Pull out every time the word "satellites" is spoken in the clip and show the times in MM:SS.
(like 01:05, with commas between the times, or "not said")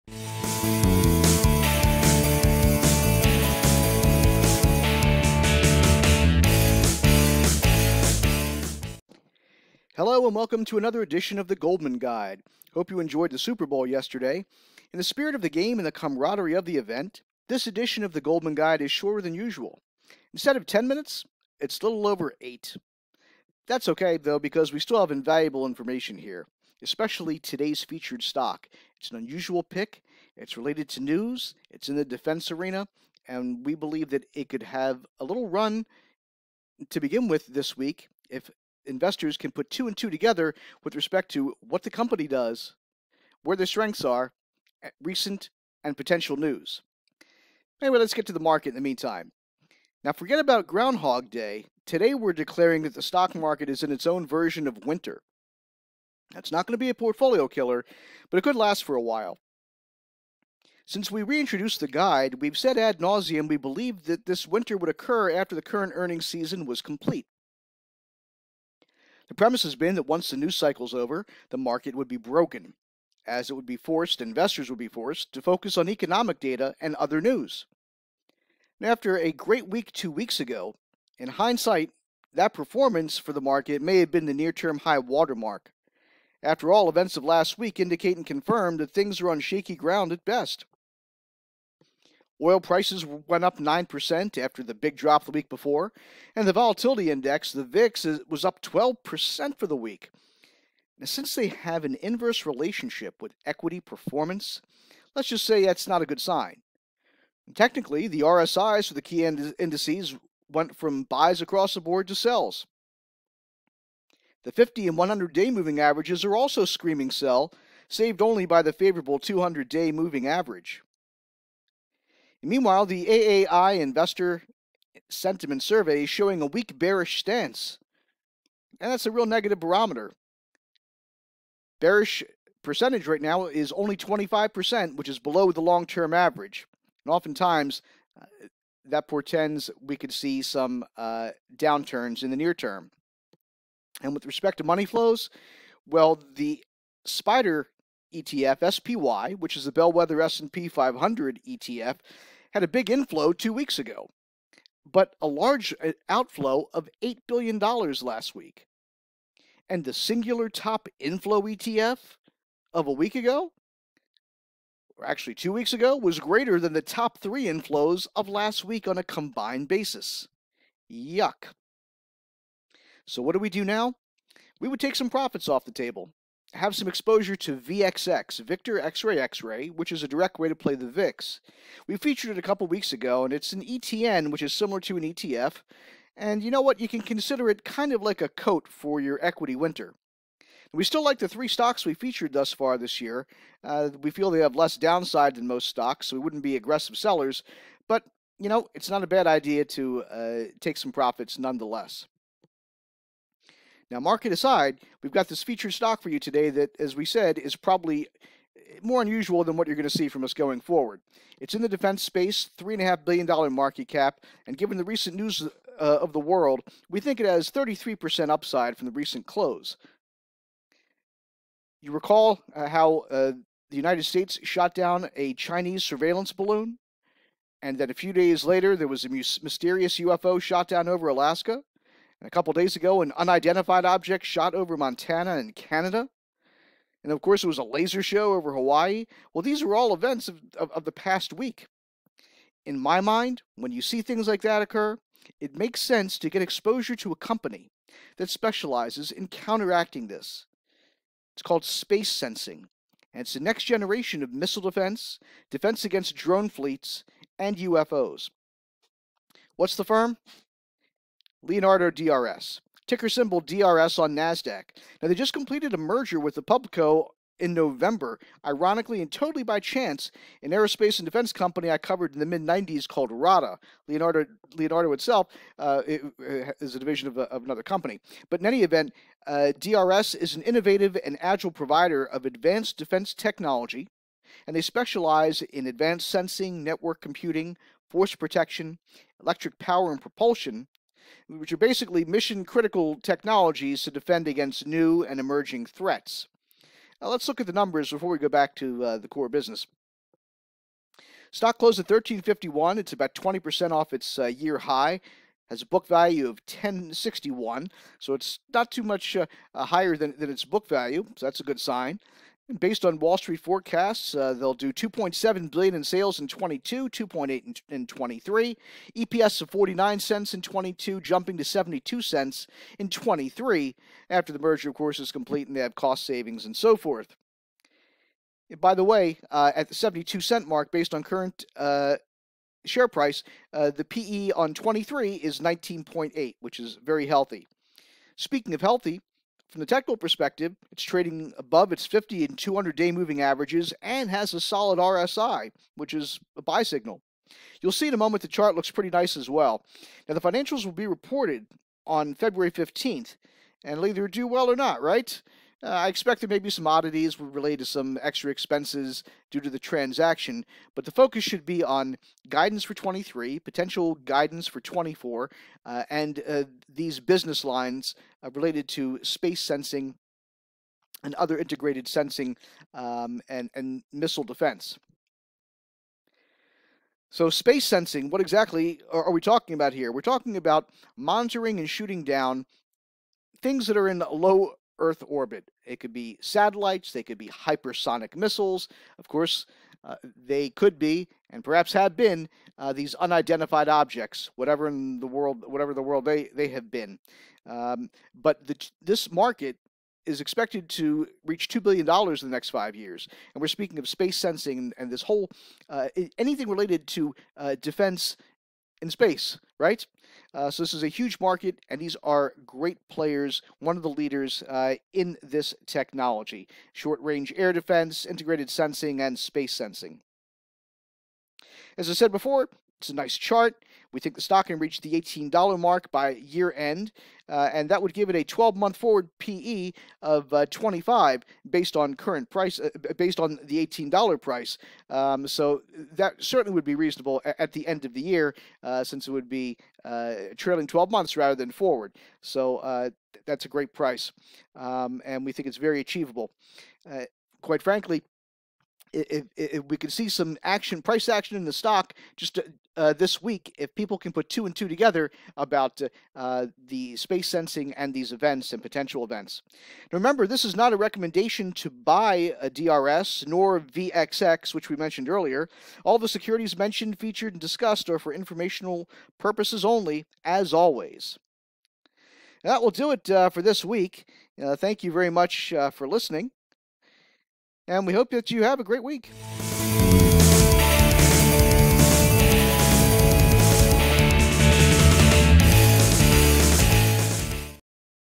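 06:26.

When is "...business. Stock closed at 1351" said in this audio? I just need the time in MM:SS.
04:59.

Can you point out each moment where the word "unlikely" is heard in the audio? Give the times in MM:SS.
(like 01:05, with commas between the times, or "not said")
not said.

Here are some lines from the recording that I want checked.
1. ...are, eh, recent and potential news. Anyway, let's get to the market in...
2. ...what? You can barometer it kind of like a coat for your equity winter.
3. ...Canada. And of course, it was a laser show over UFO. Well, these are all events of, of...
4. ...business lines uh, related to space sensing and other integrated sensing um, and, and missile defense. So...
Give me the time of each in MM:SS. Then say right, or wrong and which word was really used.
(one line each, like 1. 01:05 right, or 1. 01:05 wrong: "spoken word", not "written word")
1. 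00:44 right
2. 03:06 wrong: "consider", not "barometer"
3. 03:55 wrong: "Hawaii", not "UFO"
4. 06:06 right.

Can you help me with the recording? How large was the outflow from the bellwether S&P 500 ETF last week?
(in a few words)
$8 billion.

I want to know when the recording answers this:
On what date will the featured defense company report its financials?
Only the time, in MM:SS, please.
05:52.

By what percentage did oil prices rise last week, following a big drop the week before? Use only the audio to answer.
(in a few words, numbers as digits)
9%.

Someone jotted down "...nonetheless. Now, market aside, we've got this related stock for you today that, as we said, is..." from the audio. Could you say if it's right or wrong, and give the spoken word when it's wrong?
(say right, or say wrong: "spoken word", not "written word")
wrong: "featured", not "related".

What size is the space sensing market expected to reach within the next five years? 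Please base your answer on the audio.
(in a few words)
$2 billion.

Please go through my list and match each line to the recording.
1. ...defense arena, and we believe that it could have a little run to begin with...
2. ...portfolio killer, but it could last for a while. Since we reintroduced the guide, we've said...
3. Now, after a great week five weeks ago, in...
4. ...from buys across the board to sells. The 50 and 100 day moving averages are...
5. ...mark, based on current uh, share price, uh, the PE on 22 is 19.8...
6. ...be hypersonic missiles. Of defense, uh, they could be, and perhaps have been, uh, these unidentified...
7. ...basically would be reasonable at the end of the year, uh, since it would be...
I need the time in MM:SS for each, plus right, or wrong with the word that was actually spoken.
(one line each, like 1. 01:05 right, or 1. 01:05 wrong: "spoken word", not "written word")
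1. 00:32 right
2. 00:56 right
3. 01:18 wrong: "two", not "five"
4. 01:50 right
5. 05:30 wrong: "23", not "22"
6. 06:27 wrong: "course", not "defense"
7. 07:16 wrong: "certainly", not "basically".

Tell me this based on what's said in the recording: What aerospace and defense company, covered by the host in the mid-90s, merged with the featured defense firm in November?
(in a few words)
RADA.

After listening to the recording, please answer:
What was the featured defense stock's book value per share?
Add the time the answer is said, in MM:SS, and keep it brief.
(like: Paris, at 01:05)
10.61, at 05:06.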